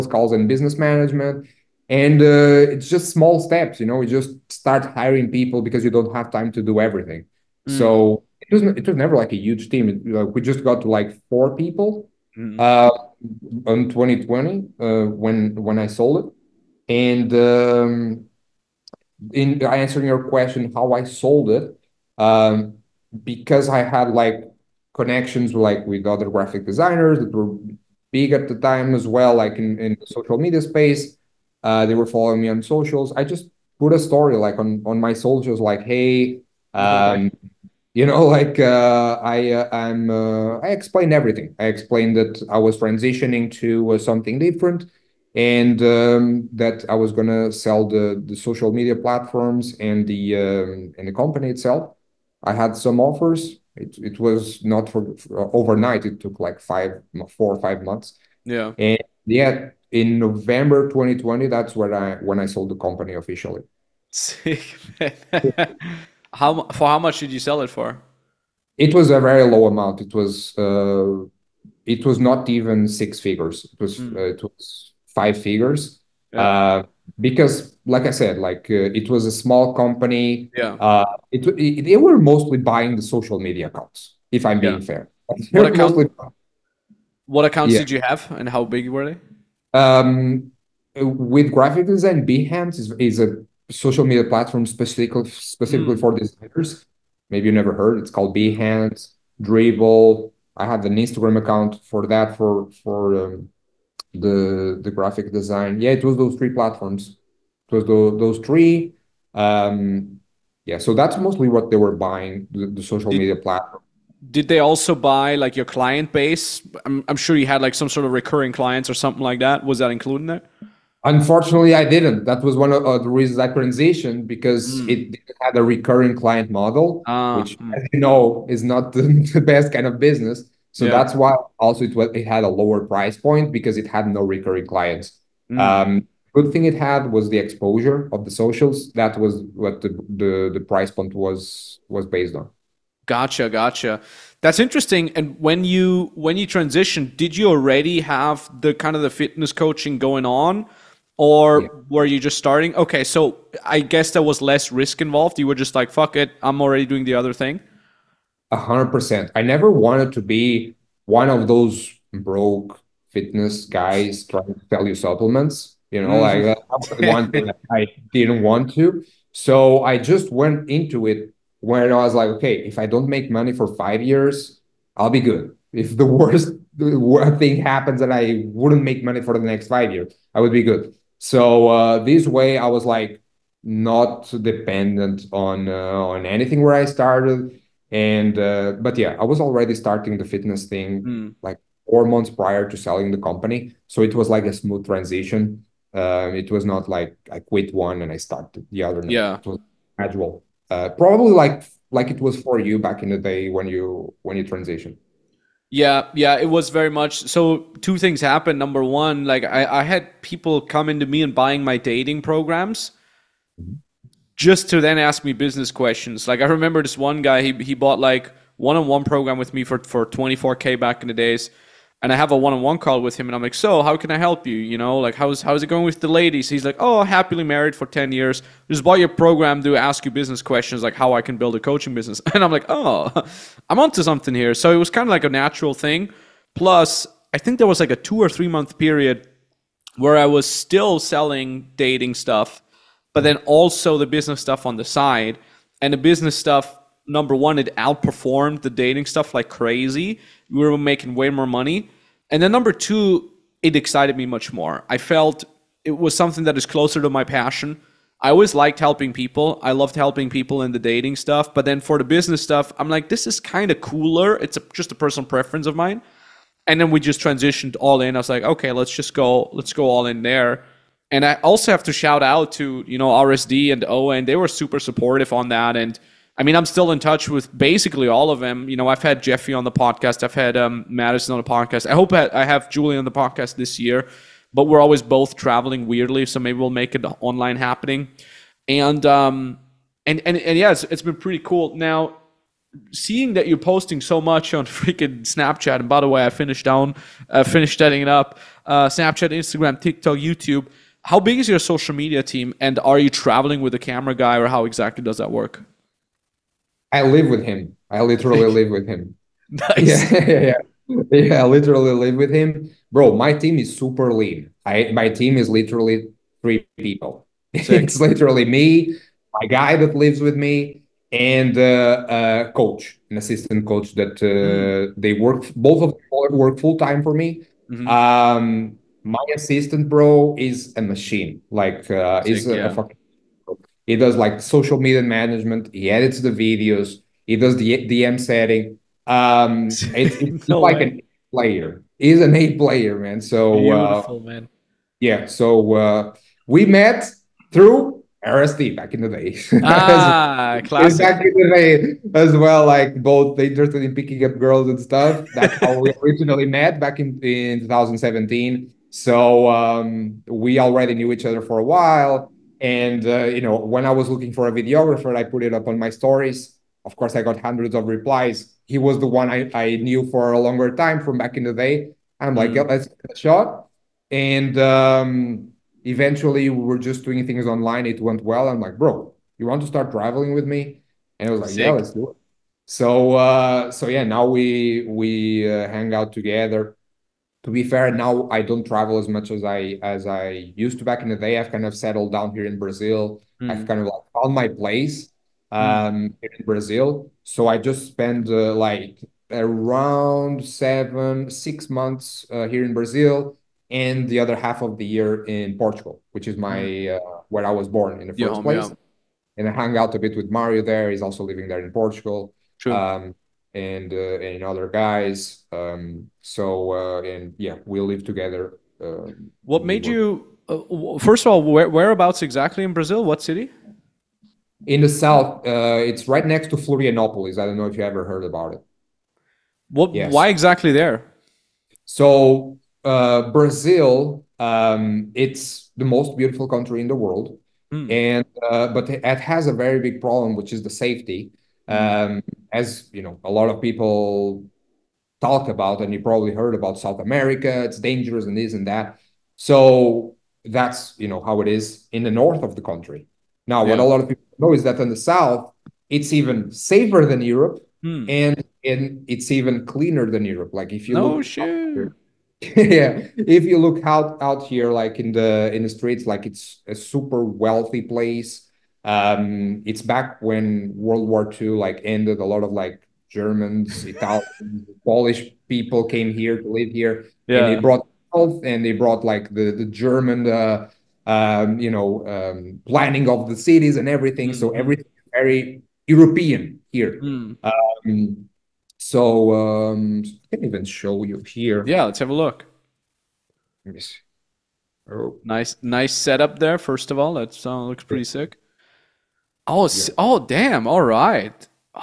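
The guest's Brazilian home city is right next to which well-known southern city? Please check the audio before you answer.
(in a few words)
Florianopolis.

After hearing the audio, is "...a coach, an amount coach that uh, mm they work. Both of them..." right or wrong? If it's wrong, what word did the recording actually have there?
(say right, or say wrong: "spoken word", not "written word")
wrong: "assistant", not "amount".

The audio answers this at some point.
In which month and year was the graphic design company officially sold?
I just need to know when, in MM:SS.
01:00.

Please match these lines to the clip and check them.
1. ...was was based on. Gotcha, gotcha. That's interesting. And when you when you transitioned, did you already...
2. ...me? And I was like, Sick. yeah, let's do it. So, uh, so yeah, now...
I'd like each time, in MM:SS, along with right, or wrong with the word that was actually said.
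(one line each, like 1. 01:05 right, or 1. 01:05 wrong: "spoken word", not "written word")
1. 02:21 right
2. 06:20 right.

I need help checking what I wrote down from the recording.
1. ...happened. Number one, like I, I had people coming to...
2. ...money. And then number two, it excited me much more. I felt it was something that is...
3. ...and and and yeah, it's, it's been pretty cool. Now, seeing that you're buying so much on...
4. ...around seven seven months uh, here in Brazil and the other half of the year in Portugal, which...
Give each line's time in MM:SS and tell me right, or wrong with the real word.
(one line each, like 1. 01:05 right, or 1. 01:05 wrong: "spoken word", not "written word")
1. 03:28 right
2. 04:11 right
3. 04:50 wrong: "posting", not "buying"
4. 06:39 wrong: "six", not "seven".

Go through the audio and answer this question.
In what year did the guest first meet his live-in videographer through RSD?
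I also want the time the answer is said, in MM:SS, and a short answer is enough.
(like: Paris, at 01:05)
2017, at 05:57.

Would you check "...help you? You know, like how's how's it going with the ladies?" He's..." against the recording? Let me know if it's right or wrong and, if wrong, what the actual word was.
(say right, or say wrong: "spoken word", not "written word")
right.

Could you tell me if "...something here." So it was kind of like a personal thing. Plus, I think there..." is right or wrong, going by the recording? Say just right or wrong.
wrong.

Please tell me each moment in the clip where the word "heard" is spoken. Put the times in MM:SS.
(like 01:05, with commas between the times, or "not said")
01:37, 07:08, 07:26.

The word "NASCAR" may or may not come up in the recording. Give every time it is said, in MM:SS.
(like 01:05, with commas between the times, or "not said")
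not said.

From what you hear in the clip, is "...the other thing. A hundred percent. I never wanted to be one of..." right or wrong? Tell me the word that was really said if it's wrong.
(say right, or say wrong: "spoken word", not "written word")
right.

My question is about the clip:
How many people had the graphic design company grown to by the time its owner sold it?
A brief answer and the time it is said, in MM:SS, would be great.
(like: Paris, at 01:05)
4, at 00:11.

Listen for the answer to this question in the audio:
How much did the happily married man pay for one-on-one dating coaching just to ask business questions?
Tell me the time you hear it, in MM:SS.
03:40.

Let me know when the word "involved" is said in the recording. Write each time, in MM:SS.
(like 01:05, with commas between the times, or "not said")
02:35.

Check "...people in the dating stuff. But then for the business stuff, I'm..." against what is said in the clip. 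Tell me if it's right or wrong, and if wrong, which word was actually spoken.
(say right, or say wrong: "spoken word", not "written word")
right.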